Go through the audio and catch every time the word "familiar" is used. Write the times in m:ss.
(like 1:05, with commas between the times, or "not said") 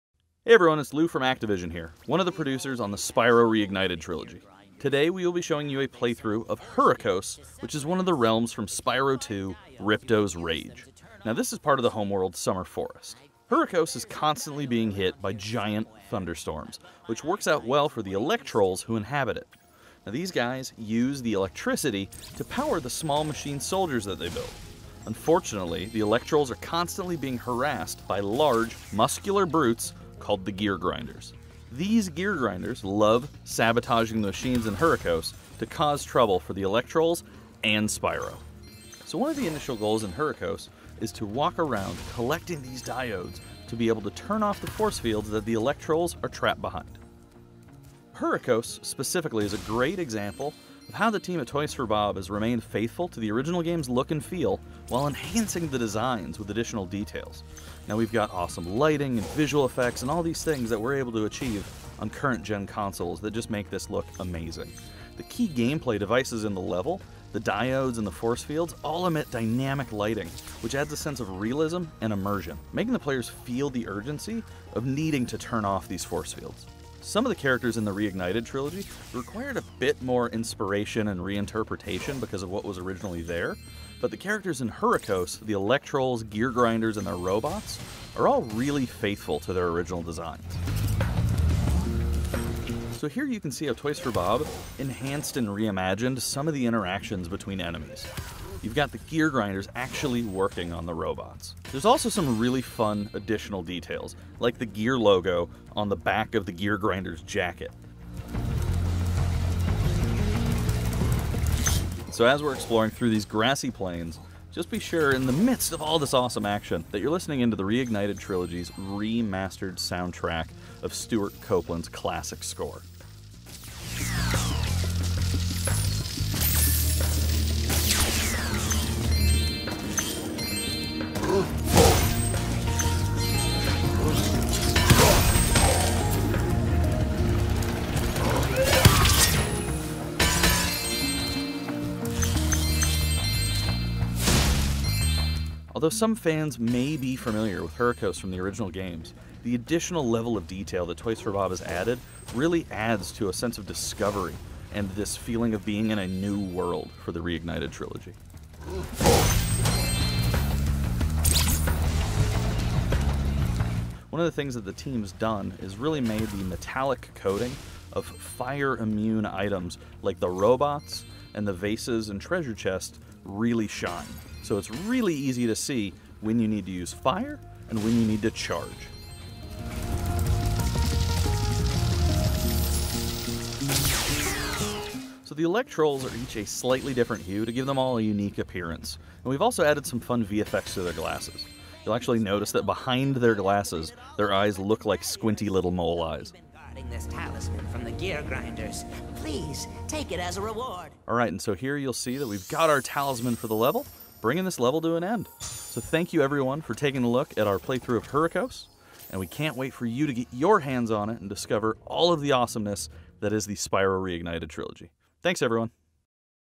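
2:27.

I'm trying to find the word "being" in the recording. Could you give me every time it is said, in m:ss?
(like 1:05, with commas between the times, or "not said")
0:14, 0:27, 2:35.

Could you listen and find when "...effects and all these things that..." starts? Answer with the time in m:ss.
0:59.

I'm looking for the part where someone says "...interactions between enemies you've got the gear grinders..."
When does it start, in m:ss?
1:36.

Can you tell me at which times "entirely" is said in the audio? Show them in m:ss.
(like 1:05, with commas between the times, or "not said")
not said.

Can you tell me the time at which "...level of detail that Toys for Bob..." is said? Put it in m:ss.
2:30.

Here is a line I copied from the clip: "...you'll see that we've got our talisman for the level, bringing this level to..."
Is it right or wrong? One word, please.
right.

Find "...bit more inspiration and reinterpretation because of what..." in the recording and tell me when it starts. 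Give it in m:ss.
1:19.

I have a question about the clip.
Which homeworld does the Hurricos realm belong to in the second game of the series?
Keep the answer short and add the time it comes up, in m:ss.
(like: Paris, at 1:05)
Summer Forest, at 0:12.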